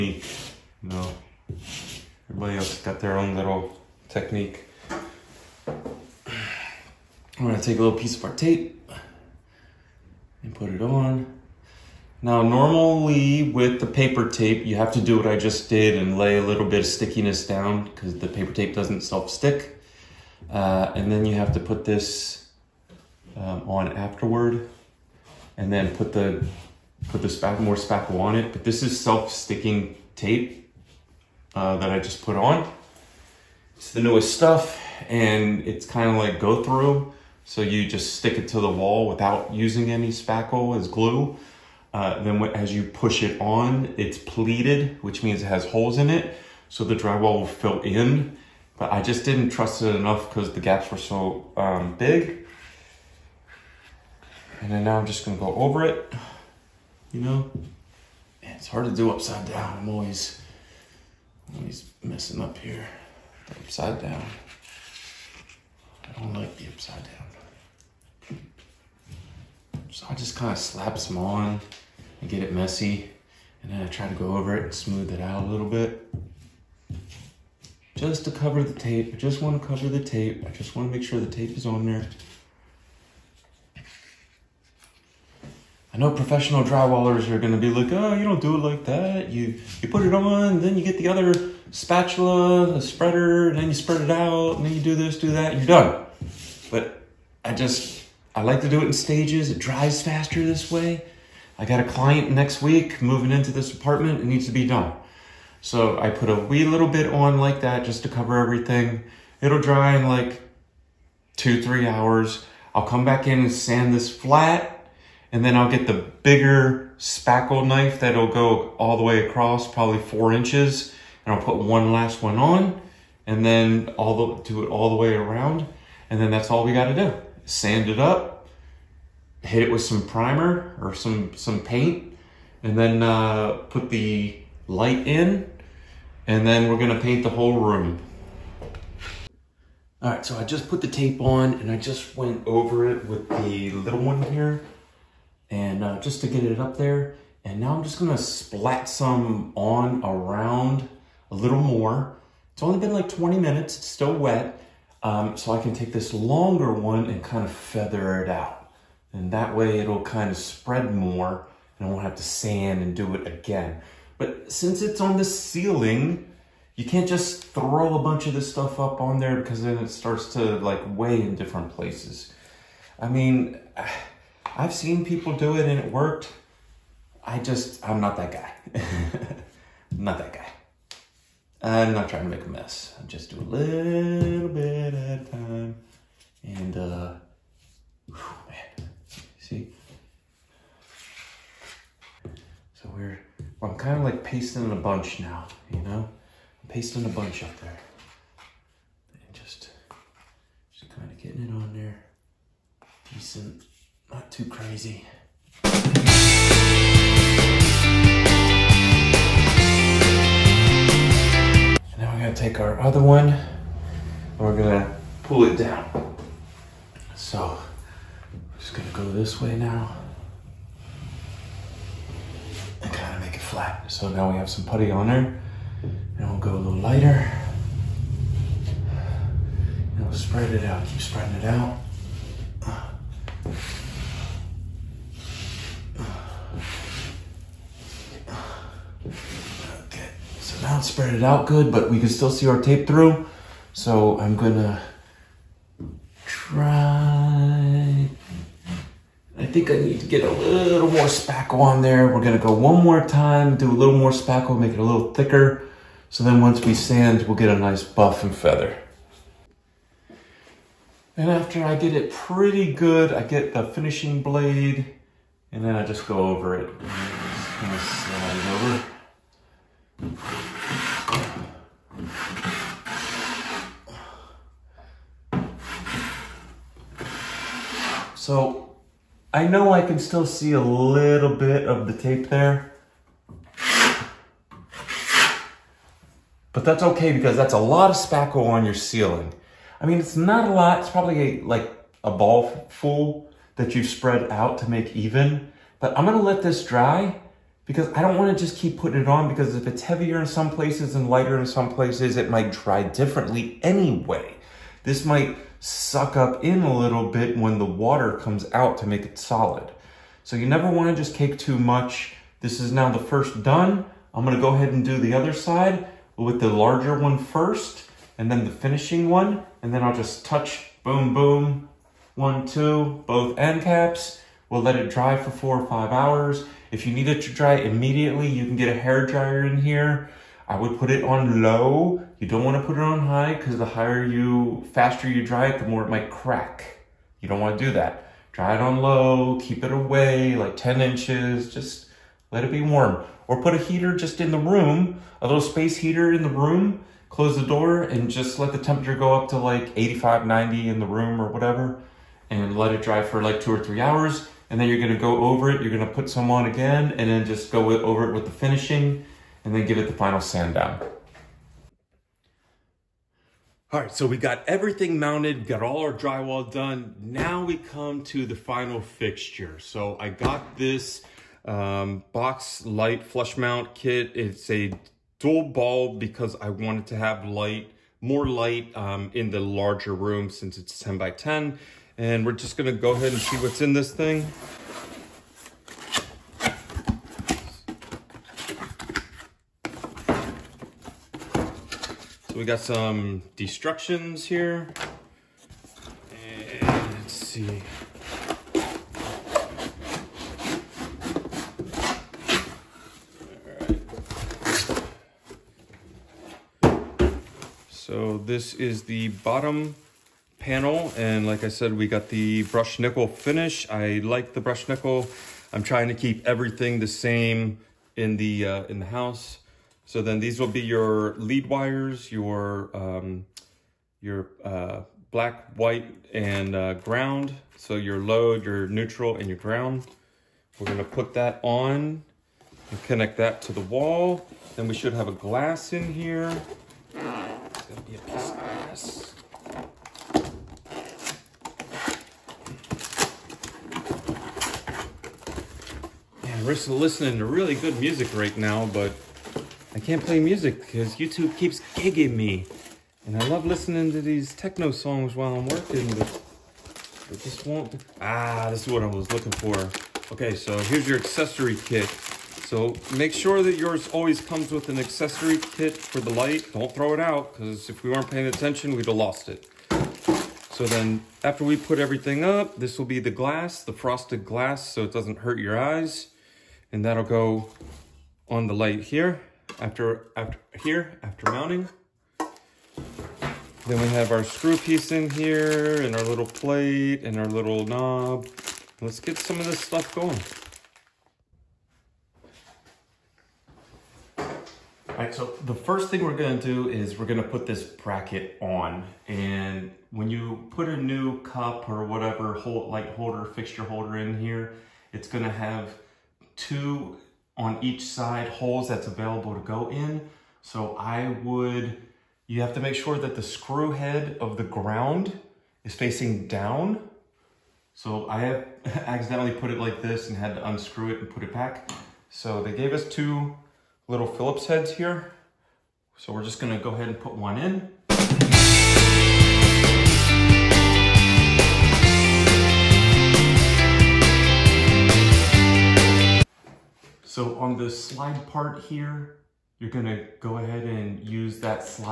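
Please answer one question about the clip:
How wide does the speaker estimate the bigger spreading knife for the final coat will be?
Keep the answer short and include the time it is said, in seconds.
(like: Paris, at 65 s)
4 inches, at 119 s.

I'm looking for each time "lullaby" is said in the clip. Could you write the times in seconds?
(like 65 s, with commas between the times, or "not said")
not said.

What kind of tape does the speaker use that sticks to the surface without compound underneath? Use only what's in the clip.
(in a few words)
self-sticking tape.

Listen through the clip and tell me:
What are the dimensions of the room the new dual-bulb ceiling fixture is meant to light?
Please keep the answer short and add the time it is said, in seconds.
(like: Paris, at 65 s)
10 by 10, at 380 s.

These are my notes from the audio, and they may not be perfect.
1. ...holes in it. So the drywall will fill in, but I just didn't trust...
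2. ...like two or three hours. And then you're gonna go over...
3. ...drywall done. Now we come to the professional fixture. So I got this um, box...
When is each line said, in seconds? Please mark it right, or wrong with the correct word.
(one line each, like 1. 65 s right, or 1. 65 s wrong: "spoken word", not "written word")
1. 45 s right
2. 353 s right
3. 365 s wrong: "final", not "professional".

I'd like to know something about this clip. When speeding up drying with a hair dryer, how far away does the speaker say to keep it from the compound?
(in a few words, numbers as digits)
10 inches.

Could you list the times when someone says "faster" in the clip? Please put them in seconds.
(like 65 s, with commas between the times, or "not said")
99 s, 334 s.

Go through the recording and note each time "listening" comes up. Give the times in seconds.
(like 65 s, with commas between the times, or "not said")
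446 s, 453 s.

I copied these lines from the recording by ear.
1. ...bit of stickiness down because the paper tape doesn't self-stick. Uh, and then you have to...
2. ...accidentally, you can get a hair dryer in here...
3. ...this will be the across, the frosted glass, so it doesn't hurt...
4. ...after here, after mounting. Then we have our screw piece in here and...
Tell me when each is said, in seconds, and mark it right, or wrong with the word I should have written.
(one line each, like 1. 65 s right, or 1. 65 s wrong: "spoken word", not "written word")
1. 16 s right
2. 327 s wrong: "immediately", not "accidentally"
3. 472 s wrong: "glass", not "across"
4. 480 s right.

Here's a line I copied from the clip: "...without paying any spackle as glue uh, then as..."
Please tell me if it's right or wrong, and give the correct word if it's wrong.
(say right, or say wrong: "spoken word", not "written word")
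wrong: "using", not "paying".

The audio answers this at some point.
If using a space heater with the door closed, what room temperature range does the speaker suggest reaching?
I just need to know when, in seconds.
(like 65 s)
349 s.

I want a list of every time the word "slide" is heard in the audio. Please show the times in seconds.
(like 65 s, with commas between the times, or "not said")
267 s, 537 s.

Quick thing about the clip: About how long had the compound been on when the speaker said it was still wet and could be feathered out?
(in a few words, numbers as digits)
20 minutes.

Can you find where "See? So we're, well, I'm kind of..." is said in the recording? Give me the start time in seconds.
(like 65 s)
189 s.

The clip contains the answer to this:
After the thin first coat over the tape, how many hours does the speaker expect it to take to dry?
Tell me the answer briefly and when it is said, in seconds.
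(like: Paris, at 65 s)
2 to 3 hours, at 111 s.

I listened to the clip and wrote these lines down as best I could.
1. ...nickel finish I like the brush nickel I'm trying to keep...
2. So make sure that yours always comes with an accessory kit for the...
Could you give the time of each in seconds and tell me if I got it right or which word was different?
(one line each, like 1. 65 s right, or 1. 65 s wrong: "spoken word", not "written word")
1. 412 s right
2. 462 s right.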